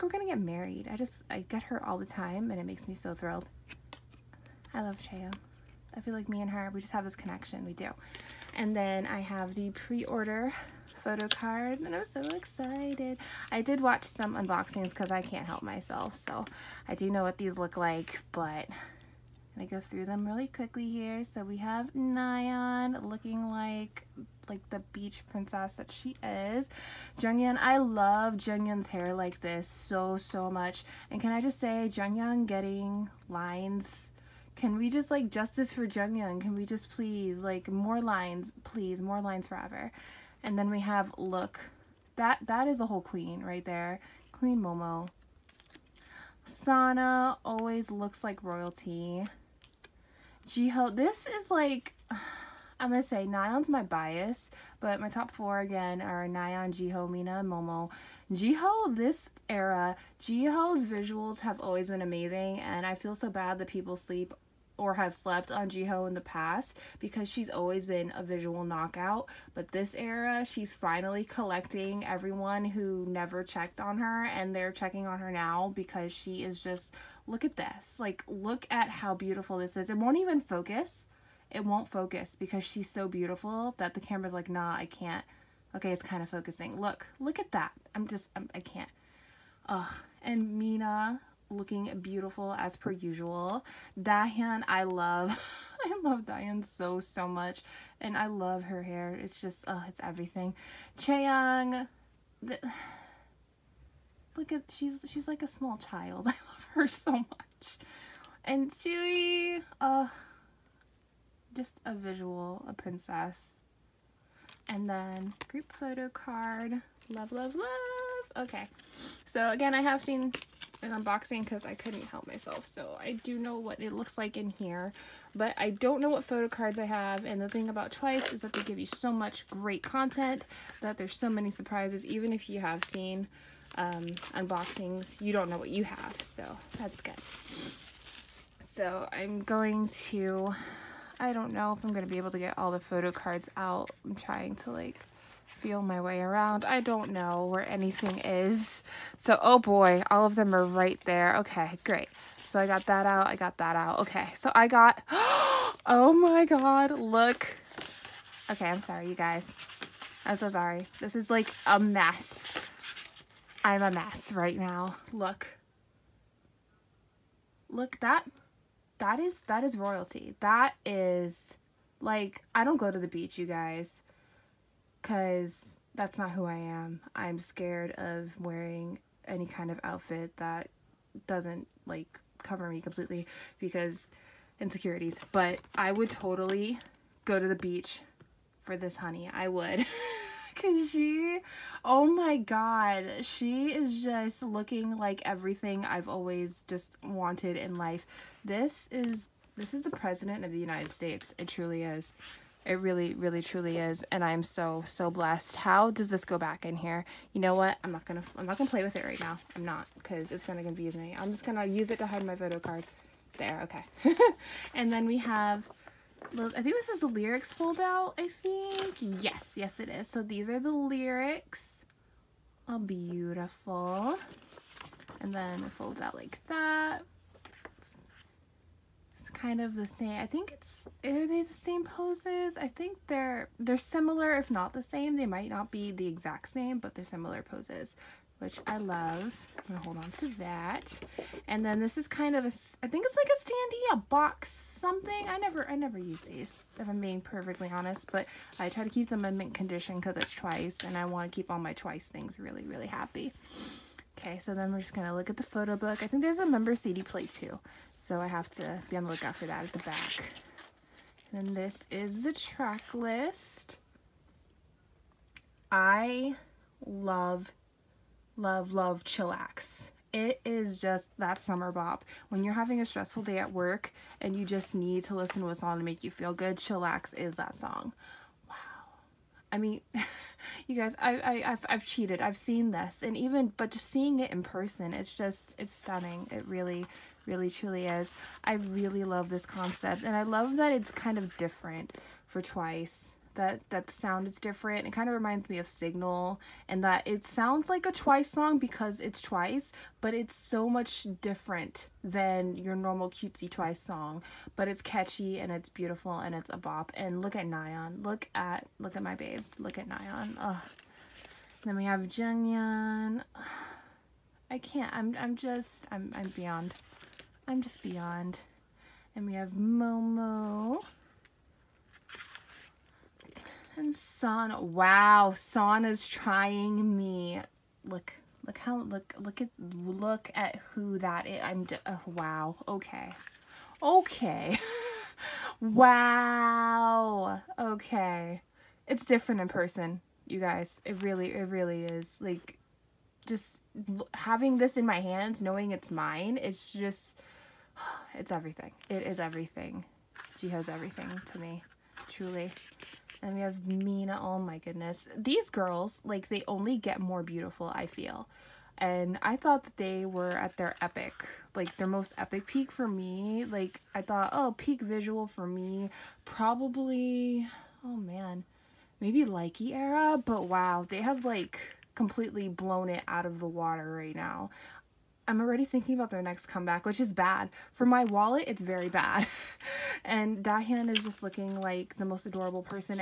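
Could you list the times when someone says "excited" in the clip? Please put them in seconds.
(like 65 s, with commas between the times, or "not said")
12 s.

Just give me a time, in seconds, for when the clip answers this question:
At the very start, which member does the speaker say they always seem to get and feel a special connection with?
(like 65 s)
5 s.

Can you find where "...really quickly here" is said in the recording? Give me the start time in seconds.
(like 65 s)
20 s.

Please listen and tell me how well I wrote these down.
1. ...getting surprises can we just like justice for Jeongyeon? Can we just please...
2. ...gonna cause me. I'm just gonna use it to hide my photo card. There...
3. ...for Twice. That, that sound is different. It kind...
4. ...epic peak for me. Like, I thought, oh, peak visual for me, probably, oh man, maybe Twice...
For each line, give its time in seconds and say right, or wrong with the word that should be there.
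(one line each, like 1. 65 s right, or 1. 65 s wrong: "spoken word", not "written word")
1. 32 s wrong: "lines", not "surprises"
2. 210 s wrong: "confuse", not "cause"
3. 292 s right
4. 362 s wrong: "Likey", not "Twice".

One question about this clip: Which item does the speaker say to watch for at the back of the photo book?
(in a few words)
Member CD plate.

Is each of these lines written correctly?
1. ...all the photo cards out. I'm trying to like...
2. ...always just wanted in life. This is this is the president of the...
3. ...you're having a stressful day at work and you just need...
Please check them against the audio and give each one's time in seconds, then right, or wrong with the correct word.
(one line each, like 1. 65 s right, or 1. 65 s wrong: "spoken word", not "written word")
1. 142 s right
2. 196 s right
3. 272 s right.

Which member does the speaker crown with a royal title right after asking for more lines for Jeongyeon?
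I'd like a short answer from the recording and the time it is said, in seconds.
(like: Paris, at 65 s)
Queen Momo, at 44 s.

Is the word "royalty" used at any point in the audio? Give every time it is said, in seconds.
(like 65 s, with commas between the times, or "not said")
48 s, 169 s.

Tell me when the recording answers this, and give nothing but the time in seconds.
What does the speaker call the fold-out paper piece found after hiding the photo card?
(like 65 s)
217 s.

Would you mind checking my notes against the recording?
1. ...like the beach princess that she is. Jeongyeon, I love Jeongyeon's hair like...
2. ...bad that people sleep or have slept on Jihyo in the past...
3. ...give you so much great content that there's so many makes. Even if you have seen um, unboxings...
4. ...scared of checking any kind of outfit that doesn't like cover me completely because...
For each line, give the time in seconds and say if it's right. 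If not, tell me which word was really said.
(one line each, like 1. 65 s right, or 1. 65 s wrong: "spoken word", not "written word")
1. 24 s right
2. 63 s right
3. 128 s wrong: "surprises", not "makes"
4. 177 s wrong: "wearing", not "checking".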